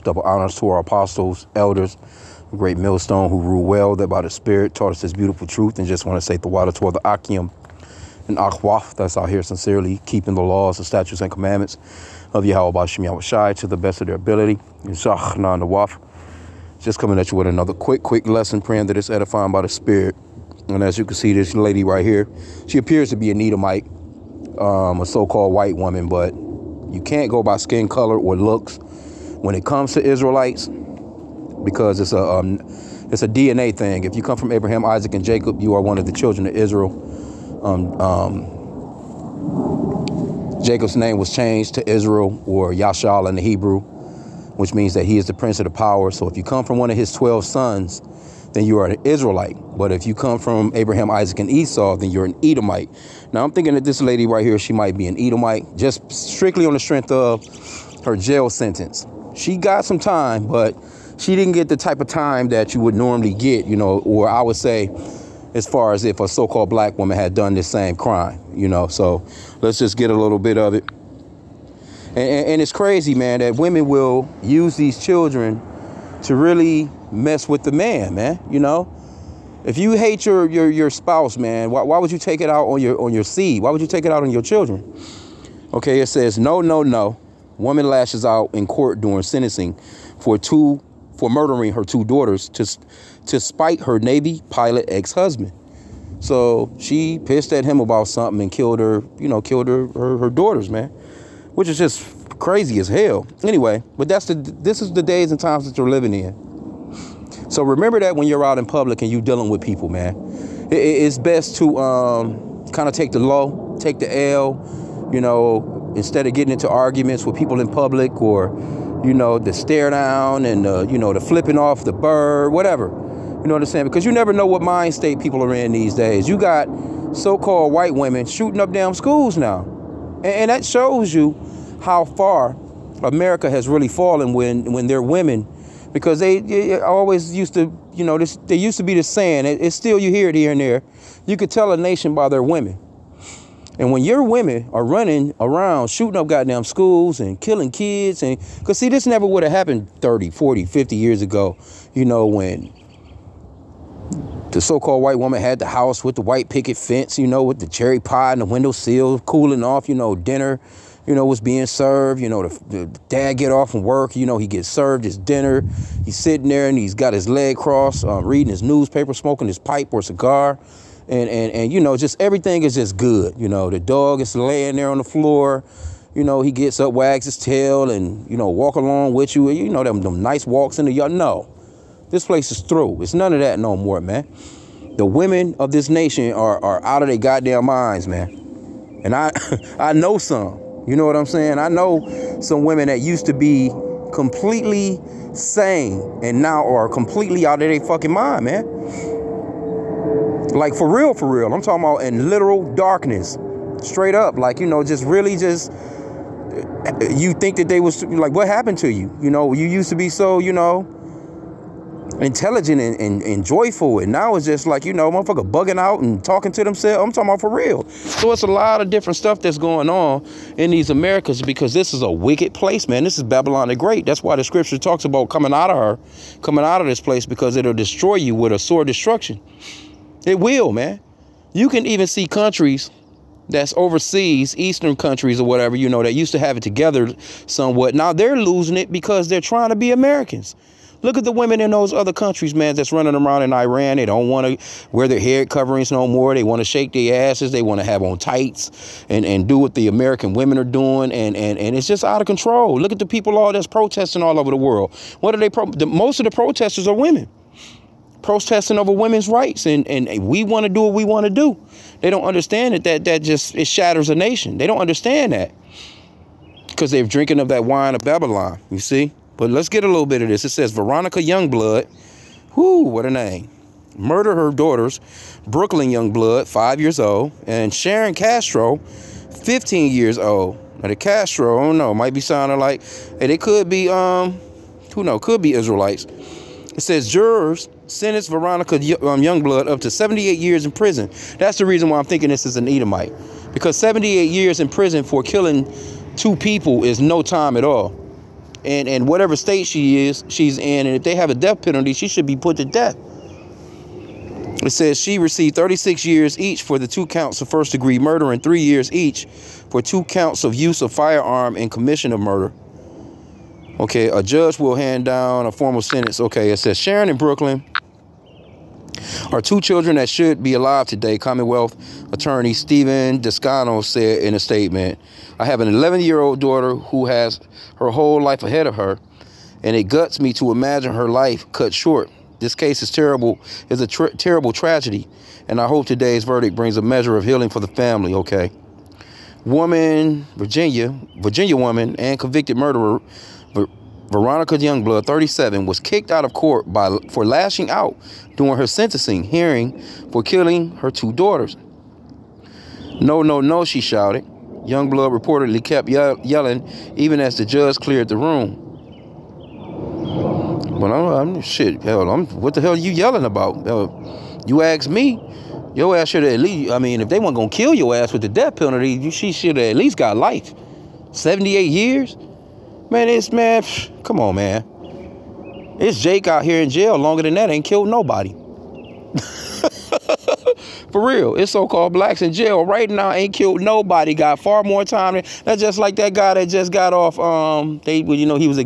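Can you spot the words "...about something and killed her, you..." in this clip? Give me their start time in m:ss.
1:37.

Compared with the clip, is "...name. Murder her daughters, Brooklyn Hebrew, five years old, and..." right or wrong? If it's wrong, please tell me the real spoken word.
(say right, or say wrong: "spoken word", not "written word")
wrong: "Youngblood", not "Hebrew".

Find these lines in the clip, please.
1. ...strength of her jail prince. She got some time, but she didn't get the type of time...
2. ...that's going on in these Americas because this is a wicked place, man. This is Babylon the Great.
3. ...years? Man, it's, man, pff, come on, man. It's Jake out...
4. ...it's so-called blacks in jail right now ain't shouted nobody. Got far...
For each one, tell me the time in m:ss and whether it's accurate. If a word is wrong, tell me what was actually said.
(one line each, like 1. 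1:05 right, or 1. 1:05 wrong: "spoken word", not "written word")
1. 0:56 wrong: "sentence", not "prince"
2. 3:39 right
3. 6:11 right
4. 6:21 wrong: "killed", not "shouted".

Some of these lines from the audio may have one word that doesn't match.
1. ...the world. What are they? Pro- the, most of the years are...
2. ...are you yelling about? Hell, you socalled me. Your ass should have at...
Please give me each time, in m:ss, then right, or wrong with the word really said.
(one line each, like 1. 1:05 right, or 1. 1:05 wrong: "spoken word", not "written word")
1. 4:14 wrong: "protesters", not "years"
2. 6:02 wrong: "asked", not "socalled".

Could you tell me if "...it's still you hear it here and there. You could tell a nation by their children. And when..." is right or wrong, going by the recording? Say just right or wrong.
wrong.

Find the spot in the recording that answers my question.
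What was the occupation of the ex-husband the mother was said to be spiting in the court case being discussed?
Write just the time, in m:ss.
1:33.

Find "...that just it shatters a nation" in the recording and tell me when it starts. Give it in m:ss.
4:23.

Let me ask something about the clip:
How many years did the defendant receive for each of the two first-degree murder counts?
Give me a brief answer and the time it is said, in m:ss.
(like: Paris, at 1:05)
36 years, at 5:05.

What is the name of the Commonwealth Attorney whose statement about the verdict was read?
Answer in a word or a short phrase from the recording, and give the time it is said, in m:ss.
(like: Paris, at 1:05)
Stephen Descano, at 5:22.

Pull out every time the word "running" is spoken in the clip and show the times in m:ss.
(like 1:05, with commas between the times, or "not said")
2:24, 4:02.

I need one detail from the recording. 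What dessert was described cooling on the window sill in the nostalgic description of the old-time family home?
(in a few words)
cherry pie.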